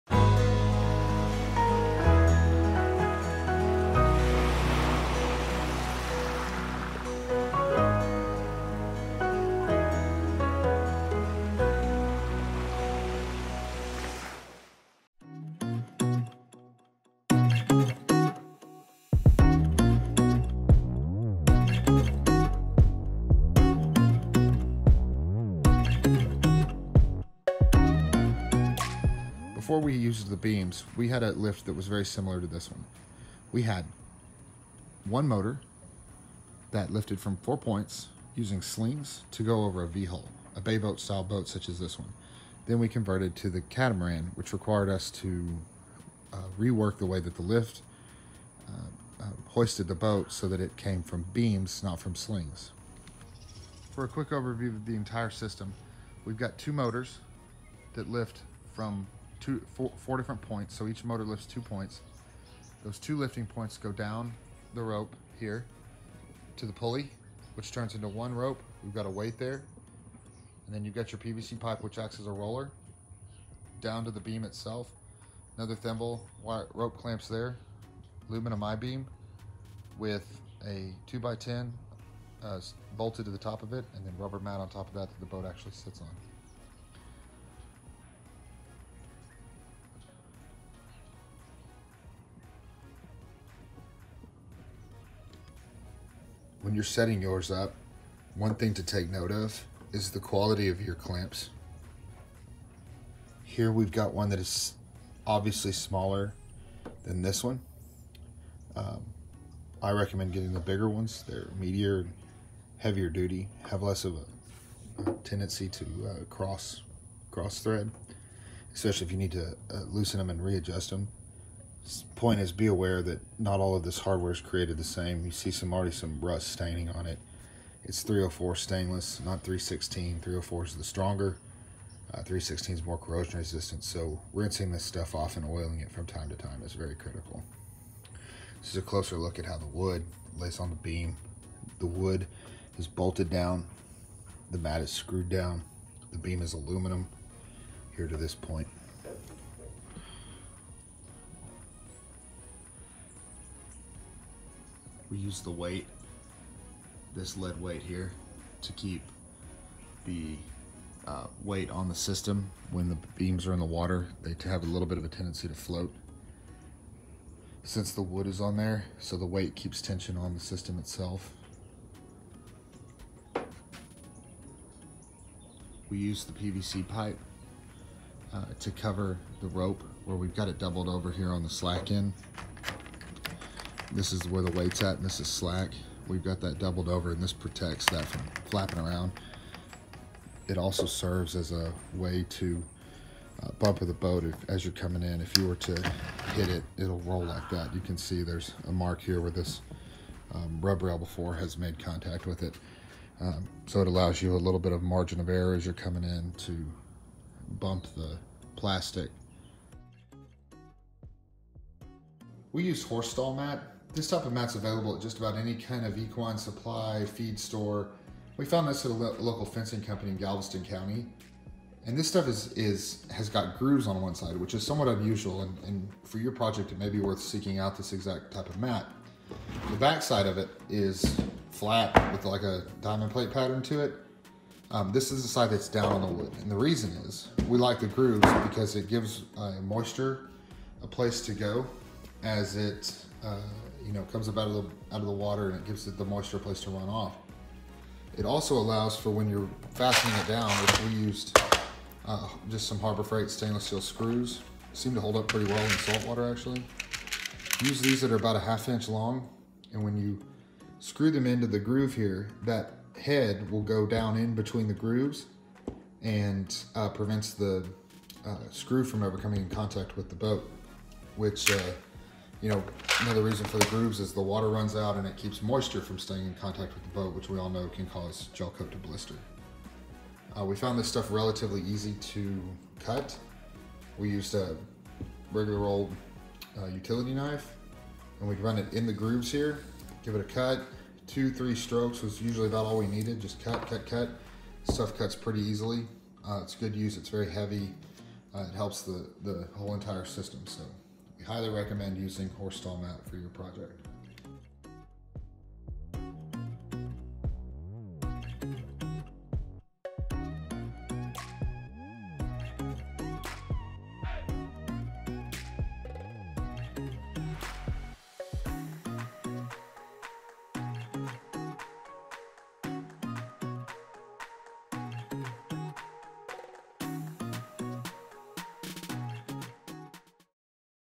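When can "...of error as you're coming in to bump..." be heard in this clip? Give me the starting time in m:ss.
3:25.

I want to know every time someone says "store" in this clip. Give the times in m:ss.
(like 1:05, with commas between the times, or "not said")
3:37.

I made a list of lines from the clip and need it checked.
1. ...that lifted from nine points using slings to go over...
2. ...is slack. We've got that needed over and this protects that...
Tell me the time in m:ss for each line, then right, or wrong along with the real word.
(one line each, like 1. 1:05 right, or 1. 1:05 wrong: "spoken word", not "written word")
1. 0:36 wrong: "four", not "nine"
2. 3:05 wrong: "doubled", not "needed".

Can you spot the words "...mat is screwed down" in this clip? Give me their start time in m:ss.
2:24.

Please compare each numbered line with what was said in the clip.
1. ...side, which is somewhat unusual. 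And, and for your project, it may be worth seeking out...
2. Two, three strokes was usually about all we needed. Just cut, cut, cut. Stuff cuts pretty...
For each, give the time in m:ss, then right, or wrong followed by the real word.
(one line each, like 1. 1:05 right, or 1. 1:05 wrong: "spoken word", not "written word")
1. 3:44 right
2. 4:51 right.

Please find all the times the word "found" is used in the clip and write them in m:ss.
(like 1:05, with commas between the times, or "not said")
3:38, 4:40.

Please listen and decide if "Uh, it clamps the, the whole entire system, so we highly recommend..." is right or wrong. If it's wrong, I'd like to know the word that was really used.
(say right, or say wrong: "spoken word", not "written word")
wrong: "helps", not "clamps".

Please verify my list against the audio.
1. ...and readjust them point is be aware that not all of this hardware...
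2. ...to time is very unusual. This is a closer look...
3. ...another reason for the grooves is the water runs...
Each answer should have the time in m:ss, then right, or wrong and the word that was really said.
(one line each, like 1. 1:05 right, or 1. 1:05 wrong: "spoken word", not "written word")
1. 2:00 right
2. 2:16 wrong: "critical", not "unusual"
3. 4:33 right.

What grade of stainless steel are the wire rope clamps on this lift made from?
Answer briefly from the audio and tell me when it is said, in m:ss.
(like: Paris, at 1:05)
304 stainless, at 2:08.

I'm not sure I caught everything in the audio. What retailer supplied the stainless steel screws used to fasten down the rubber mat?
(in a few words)
Harbor Freight.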